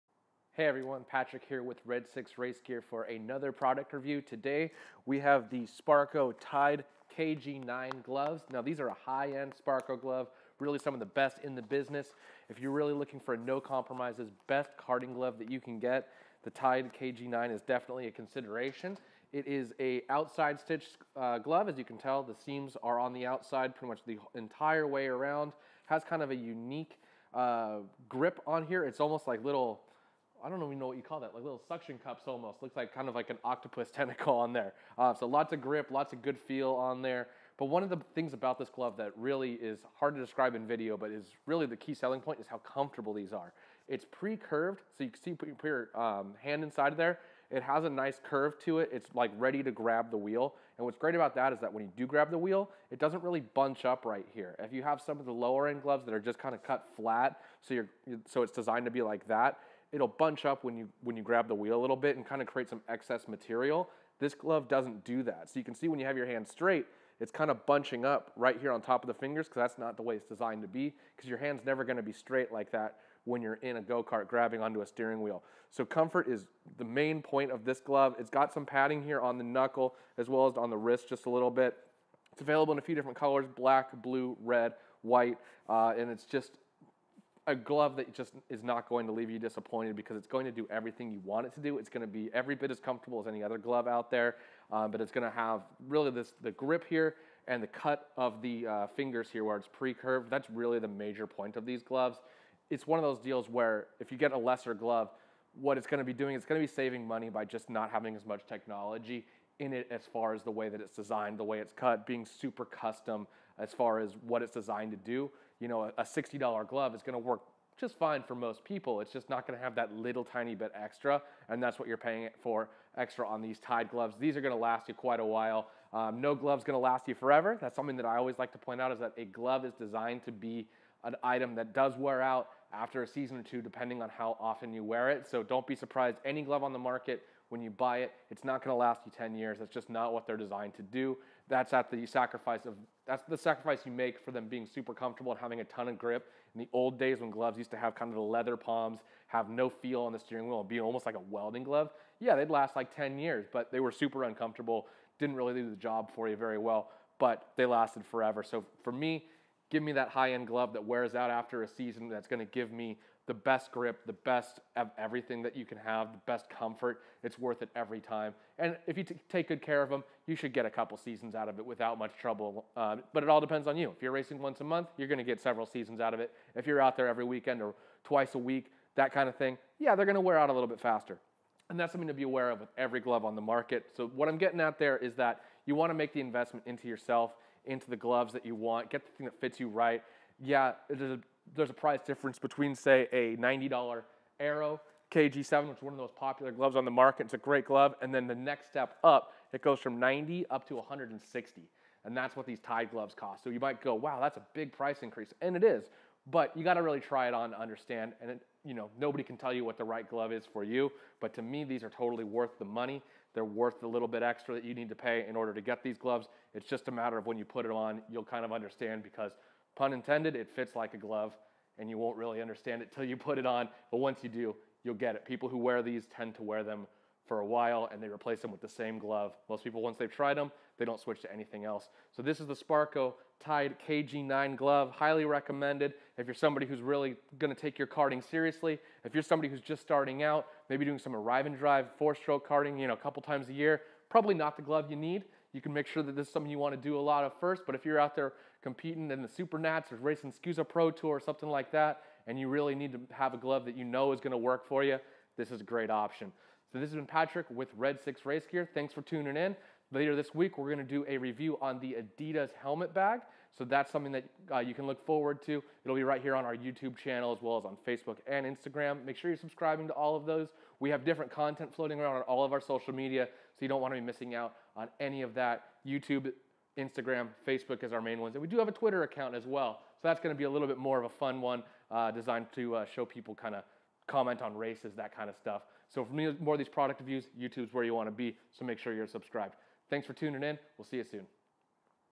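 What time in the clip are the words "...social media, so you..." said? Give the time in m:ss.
4:32.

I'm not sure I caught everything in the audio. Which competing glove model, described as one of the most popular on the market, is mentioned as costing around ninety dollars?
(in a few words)
Arrow KG7.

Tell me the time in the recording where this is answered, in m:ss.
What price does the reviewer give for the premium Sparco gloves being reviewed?
3:20.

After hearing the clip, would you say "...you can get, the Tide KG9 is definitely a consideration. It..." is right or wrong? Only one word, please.
right.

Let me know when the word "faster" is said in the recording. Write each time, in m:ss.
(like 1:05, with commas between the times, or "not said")
3:00.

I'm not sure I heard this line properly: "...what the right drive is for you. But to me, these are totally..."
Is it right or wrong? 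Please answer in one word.
wrong.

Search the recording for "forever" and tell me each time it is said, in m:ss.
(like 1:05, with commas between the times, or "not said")
2:07, 2:38.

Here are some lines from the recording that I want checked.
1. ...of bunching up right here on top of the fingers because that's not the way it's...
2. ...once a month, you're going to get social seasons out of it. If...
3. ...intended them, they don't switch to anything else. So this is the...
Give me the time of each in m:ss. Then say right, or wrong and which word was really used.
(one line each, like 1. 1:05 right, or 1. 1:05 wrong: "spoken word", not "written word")
1. 1:07 right
2. 2:54 wrong: "several", not "social"
3. 3:50 wrong: "tried", not "intended".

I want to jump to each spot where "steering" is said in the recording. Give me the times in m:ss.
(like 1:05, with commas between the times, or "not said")
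1:14, 2:30.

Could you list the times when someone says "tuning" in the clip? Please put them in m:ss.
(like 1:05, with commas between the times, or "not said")
4:19, 4:50.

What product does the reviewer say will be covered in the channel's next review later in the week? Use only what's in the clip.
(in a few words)
Adidas helmet bag.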